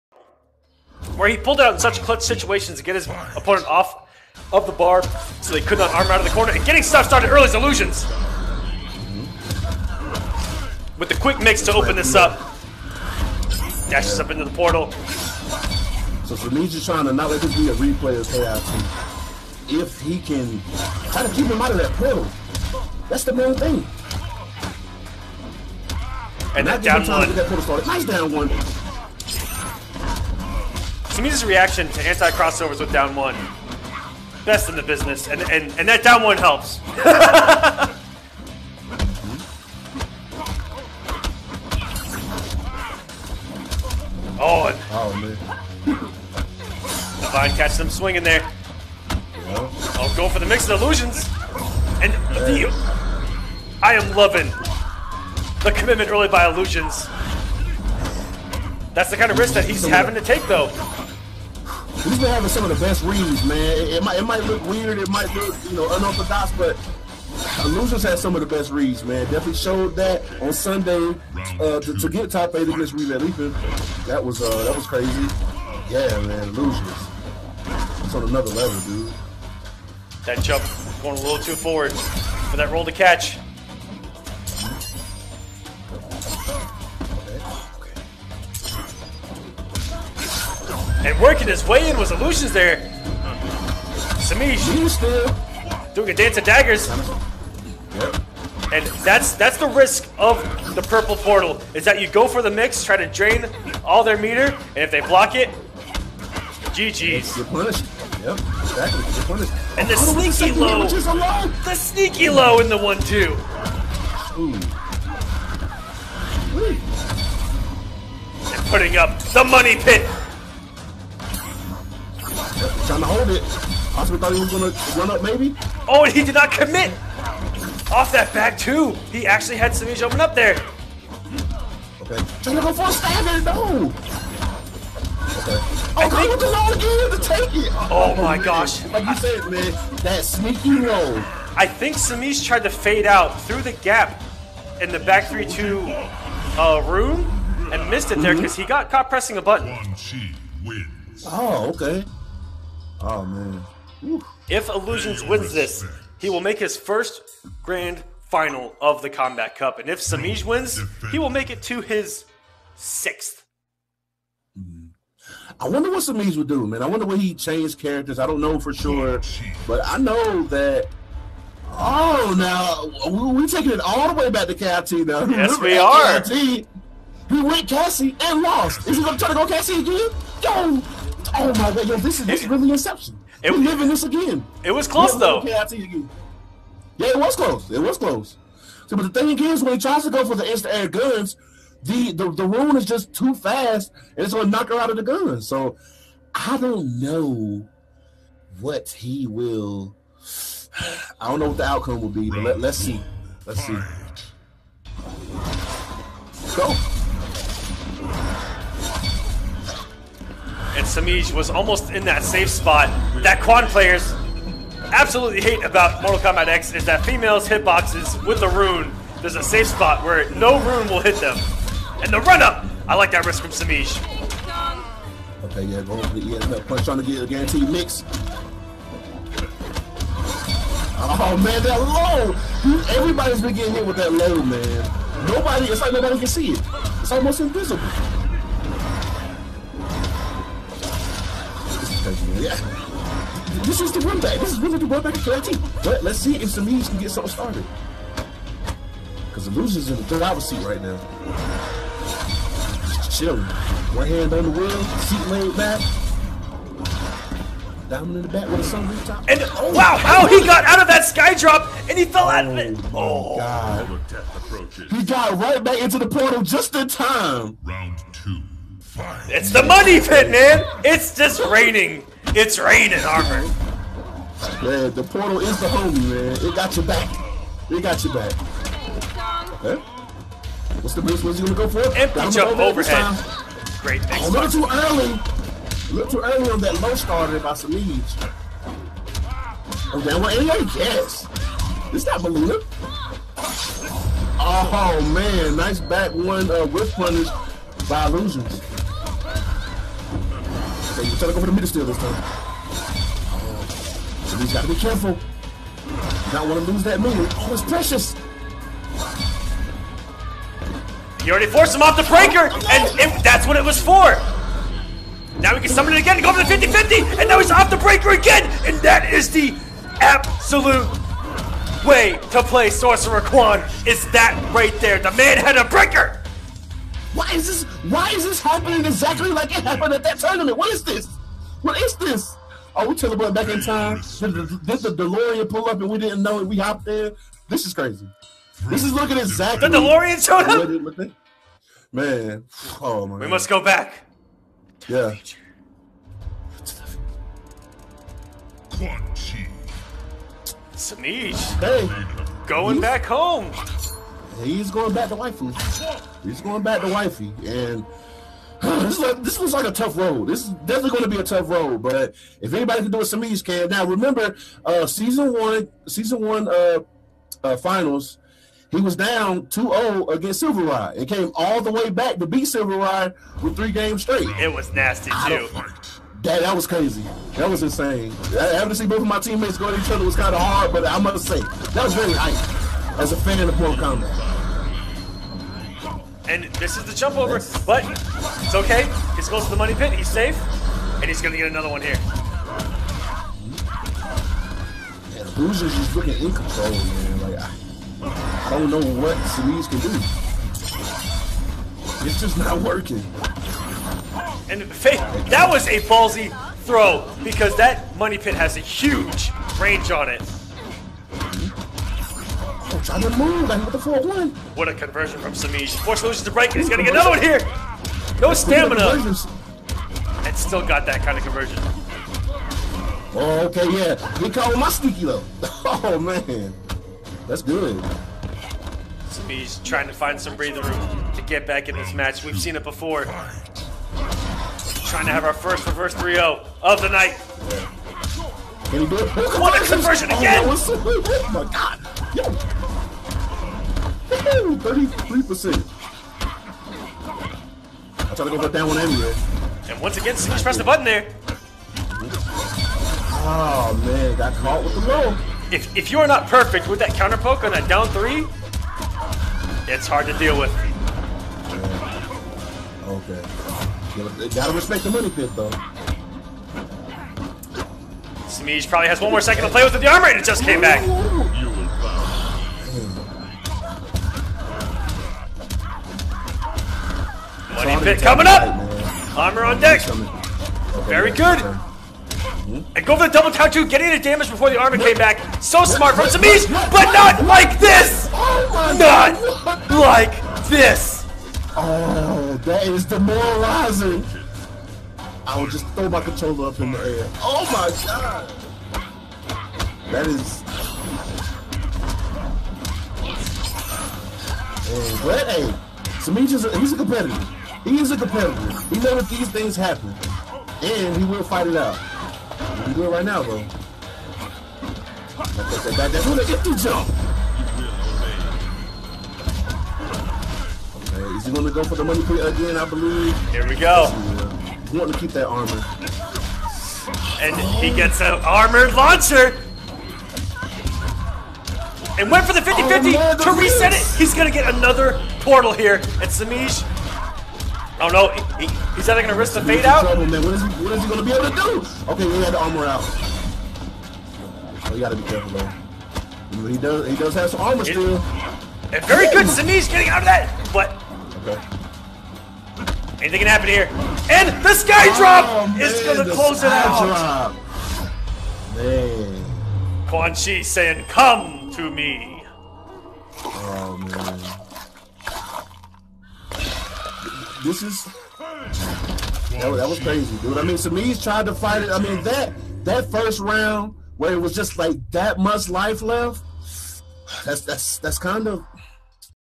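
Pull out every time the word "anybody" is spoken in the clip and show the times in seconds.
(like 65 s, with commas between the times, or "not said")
362 s.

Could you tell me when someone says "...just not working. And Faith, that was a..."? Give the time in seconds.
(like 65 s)
402 s.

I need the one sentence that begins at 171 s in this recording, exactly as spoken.
Oh, now we're taking it all the way back to KIT now.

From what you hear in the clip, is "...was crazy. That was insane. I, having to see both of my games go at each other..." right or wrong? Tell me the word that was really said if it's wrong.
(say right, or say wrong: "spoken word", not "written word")
wrong: "teammates", not "games".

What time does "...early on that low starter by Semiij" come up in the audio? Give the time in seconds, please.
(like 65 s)
286 s.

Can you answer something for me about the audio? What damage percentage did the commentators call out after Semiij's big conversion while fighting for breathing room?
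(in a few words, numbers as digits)
33%.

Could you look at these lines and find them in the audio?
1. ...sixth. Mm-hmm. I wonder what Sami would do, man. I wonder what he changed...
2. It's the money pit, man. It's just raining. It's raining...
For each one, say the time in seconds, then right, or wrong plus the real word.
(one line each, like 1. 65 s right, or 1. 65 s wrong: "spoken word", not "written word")
1. 162 s wrong: "Semiij", not "Sami"
2. 269 s right.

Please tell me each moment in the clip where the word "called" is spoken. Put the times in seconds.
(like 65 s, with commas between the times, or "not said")
424 s.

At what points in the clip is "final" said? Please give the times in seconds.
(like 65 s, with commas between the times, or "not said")
158 s, 367 s.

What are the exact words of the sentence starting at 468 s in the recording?
Smeege probably has one more second to play with the armor, and it just came back.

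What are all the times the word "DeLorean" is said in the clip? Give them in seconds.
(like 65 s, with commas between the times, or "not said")
335 s, 339 s.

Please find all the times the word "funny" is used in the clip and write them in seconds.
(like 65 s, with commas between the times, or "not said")
not said.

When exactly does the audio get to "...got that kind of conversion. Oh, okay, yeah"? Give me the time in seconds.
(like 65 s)
420 s.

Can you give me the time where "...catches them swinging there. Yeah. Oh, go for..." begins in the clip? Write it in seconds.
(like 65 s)
47 s.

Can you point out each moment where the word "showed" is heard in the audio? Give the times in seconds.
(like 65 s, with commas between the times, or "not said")
69 s, 340 s.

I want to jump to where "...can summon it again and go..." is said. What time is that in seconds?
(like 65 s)
315 s.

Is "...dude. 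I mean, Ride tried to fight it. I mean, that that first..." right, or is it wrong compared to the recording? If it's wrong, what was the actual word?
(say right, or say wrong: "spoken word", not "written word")
wrong: "Samiz", not "Ride".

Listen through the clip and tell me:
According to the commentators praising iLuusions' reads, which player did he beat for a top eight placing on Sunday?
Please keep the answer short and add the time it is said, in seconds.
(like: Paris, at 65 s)
Relay Leaping, at 72 s.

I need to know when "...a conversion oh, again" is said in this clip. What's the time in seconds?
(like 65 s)
439 s.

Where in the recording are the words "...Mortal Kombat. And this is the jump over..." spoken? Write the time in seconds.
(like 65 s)
383 s.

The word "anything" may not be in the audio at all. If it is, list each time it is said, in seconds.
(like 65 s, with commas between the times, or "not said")
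553 s.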